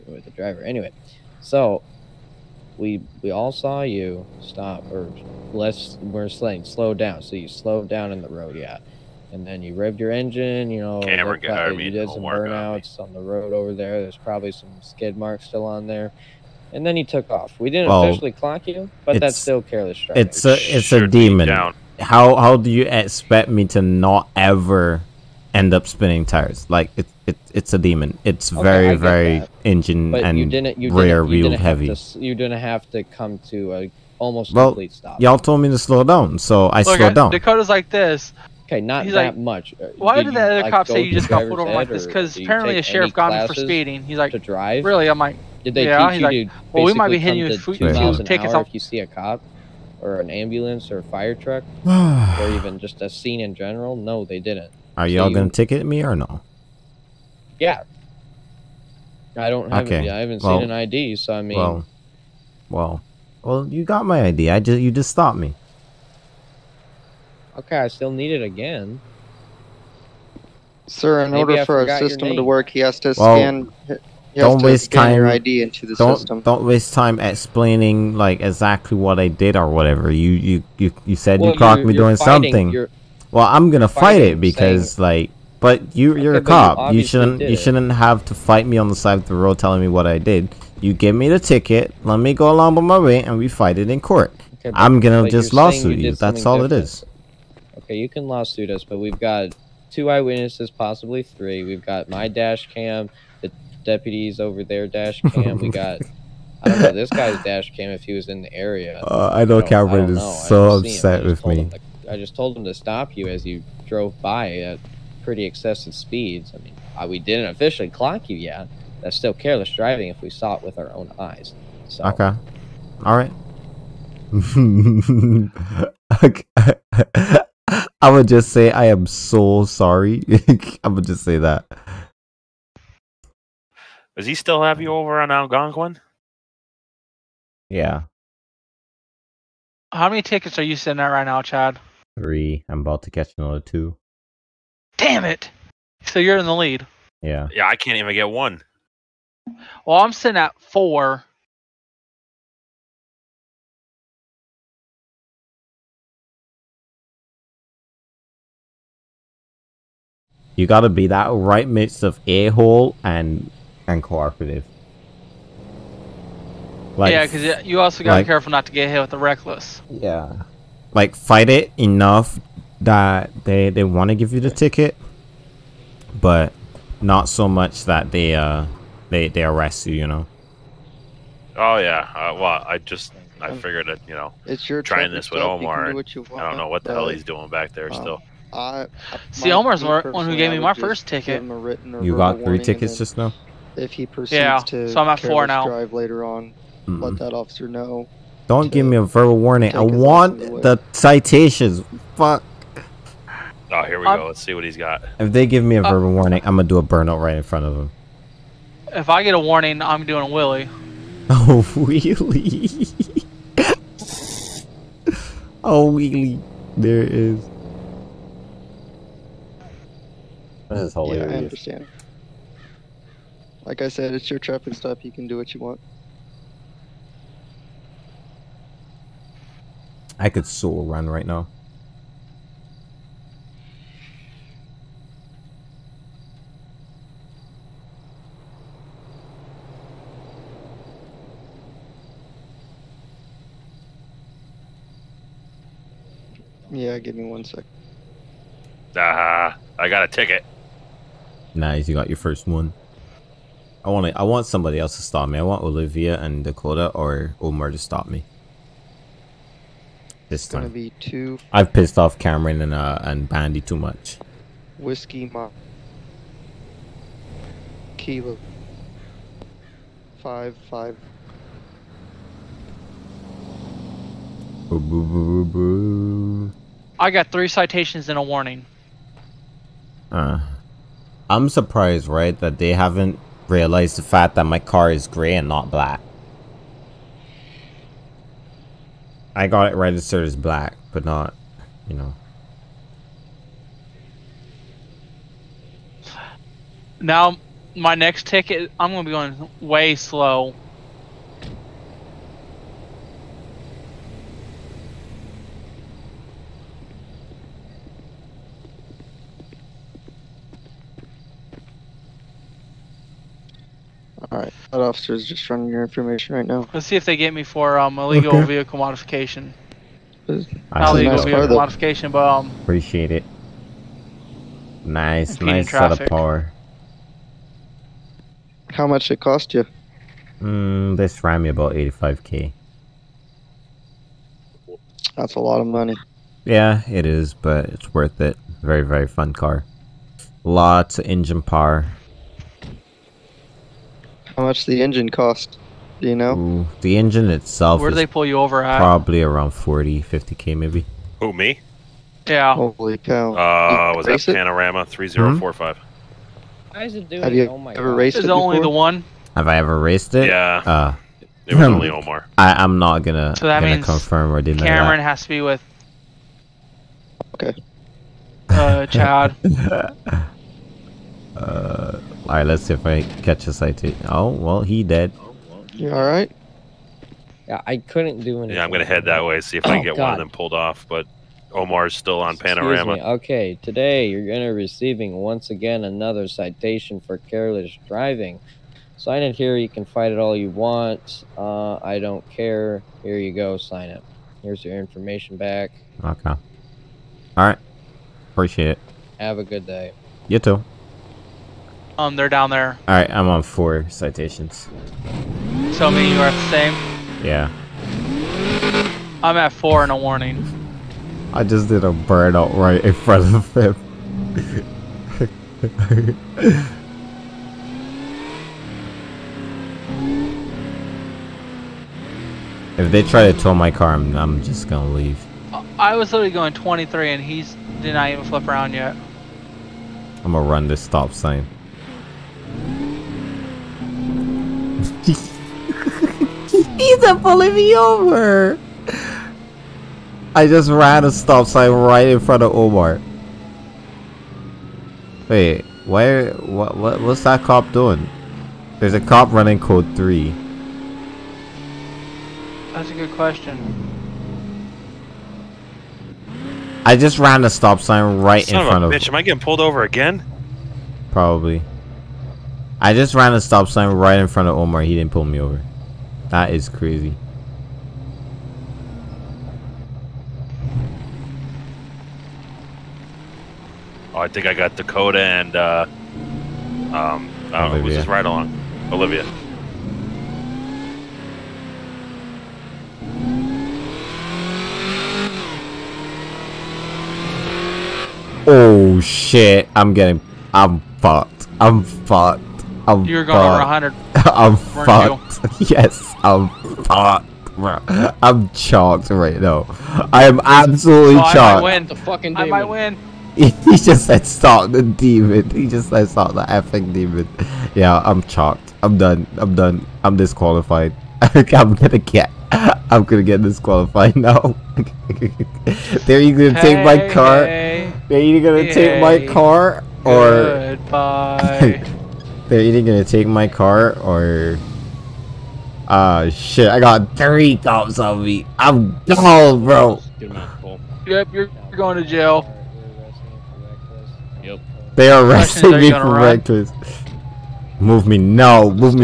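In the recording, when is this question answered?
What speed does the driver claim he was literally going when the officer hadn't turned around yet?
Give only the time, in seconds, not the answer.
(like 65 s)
426 s.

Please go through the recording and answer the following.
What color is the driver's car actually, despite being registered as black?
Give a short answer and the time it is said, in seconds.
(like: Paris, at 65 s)
Gray, at 285 s.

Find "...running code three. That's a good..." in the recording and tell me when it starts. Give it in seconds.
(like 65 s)
449 s.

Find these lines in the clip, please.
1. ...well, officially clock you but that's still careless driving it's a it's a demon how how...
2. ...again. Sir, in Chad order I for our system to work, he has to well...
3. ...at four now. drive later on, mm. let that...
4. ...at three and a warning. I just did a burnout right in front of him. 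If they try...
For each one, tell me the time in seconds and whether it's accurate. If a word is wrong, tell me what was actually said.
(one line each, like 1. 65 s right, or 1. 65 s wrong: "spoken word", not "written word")
1. 17 s right
2. 68 s wrong: "Maybe", not "Chad"
3. 195 s right
4. 409 s wrong: "four", not "three".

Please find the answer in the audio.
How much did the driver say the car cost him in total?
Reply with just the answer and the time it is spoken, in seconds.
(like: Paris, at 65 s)
$85,000, at 331 s.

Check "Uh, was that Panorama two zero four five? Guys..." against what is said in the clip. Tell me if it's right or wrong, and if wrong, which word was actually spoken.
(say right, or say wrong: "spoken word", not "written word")
wrong: "three", not "two".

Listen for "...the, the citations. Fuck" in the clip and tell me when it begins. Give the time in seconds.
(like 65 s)
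200 s.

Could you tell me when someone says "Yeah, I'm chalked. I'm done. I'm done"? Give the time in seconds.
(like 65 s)
507 s.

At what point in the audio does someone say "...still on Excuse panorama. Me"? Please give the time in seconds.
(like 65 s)
381 s.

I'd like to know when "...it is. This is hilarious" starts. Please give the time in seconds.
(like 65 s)
217 s.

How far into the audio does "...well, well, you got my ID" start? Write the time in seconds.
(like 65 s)
62 s.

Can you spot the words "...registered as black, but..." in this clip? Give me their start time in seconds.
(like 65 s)
289 s.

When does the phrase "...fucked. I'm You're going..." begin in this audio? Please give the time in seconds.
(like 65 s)
491 s.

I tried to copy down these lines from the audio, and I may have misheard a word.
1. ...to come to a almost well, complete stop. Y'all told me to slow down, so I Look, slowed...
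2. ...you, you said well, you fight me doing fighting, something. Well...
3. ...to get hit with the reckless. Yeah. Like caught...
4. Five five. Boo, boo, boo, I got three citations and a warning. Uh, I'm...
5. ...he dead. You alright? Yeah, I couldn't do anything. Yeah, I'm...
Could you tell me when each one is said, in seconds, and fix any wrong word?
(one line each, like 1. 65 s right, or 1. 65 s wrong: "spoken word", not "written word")
1. 32 s right
2. 80 s wrong: "caught", not "fight"
3. 168 s wrong: "fight", not "caught"
4. 270 s right
5. 374 s right.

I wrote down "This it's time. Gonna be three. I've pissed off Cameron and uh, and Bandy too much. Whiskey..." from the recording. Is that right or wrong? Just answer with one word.
wrong.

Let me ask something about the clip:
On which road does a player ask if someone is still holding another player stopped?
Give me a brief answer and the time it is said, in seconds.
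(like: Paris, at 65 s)
Algonquin, at 135 s.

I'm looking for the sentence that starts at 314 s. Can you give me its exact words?
Alright, that officer's just running your information right now.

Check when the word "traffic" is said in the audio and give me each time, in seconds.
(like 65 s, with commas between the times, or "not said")
224 s, 325 s.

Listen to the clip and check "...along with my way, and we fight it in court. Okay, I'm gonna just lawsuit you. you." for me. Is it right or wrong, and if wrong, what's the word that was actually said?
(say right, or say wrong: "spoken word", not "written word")
right.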